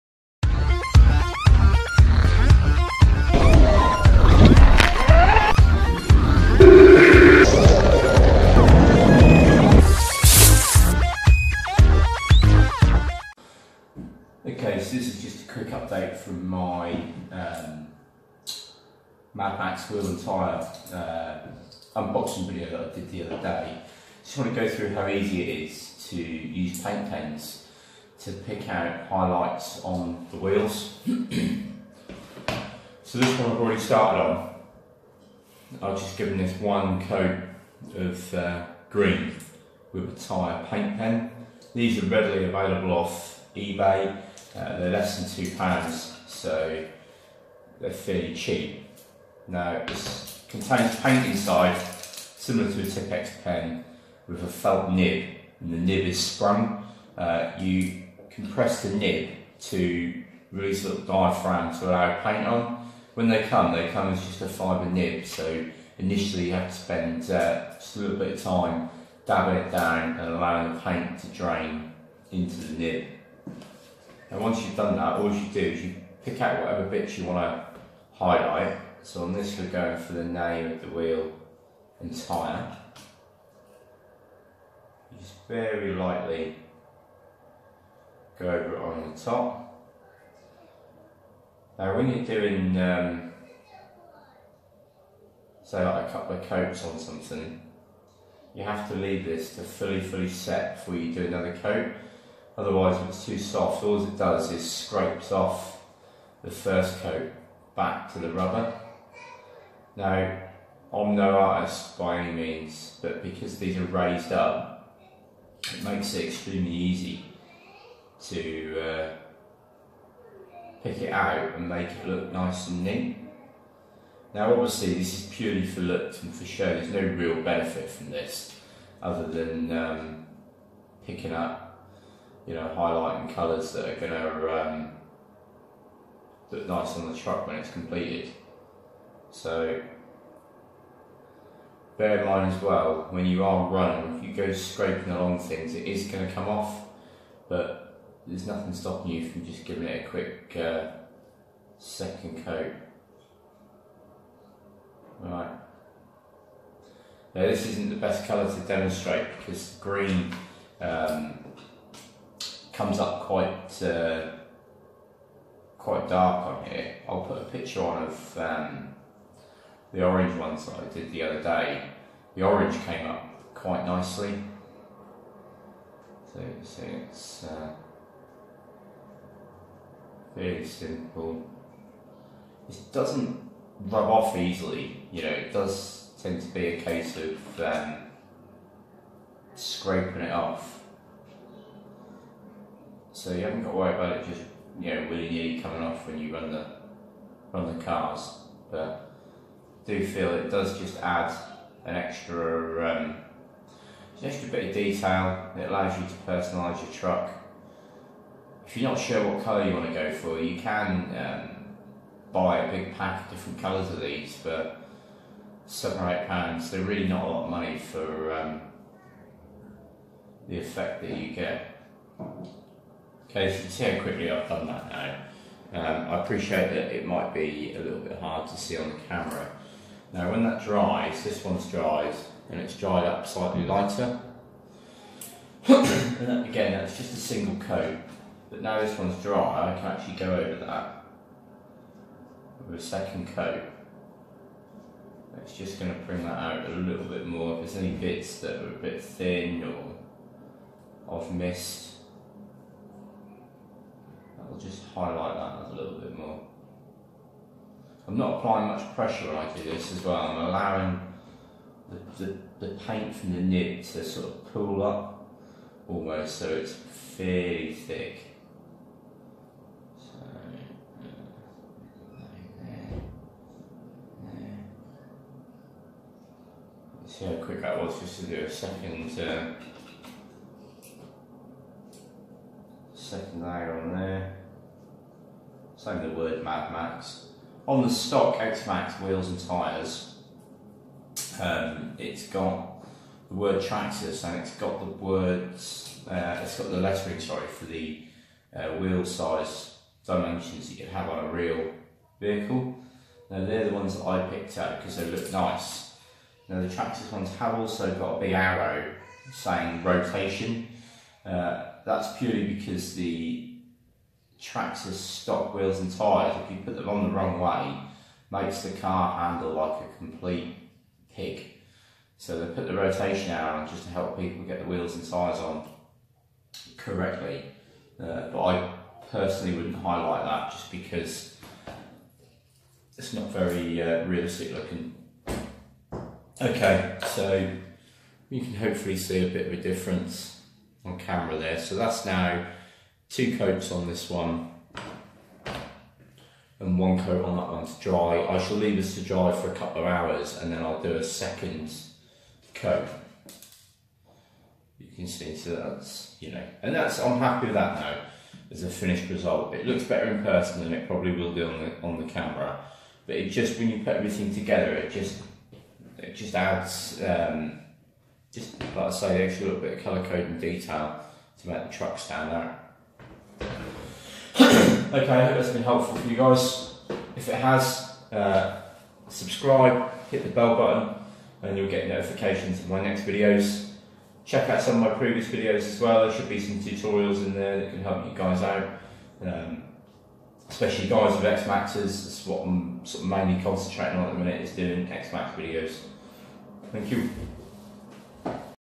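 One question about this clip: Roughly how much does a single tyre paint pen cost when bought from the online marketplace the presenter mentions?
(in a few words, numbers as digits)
Less than 2 pounds.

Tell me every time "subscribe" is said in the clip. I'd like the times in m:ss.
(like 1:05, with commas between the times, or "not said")
6:19.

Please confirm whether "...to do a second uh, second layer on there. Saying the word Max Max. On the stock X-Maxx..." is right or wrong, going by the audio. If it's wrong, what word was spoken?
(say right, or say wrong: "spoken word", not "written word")
wrong: "Mad", not "Max".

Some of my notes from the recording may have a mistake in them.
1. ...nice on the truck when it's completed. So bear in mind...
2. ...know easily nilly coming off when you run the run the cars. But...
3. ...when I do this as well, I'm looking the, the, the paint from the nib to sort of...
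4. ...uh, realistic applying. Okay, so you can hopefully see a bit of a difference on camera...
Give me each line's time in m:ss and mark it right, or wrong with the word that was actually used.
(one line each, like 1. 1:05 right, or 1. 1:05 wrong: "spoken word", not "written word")
1. 2:16 right
2. 3:14 wrong: "willy", not "easily"
3. 4:19 wrong: "allowing", not "looking"
4. 5:33 wrong: "looking", not "applying".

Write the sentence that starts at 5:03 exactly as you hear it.
Now they're the ones that I picked up because they look nice.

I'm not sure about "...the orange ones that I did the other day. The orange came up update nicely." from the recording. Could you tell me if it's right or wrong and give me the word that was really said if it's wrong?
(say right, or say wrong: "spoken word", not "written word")
wrong: "quite", not "update".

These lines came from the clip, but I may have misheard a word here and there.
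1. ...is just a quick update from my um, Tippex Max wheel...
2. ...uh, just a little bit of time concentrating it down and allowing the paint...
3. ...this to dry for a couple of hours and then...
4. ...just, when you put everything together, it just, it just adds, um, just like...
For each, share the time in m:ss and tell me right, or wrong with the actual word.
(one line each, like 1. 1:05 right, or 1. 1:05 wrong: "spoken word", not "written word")
1. 0:15 wrong: "Mad", not "Tippex"
2. 1:07 wrong: "dabbing", not "concentrating"
3. 5:48 right
4. 6:03 right.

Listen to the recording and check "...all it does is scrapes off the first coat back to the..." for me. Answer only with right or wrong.
right.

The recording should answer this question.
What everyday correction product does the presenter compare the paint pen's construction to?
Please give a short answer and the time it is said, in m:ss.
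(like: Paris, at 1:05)
Tippex pen, at 0:52.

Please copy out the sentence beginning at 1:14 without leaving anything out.
And once you've done that, all you do is you pick out whatever bits you want to highlight.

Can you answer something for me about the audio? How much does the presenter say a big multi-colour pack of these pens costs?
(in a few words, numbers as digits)
7 or 8 pounds.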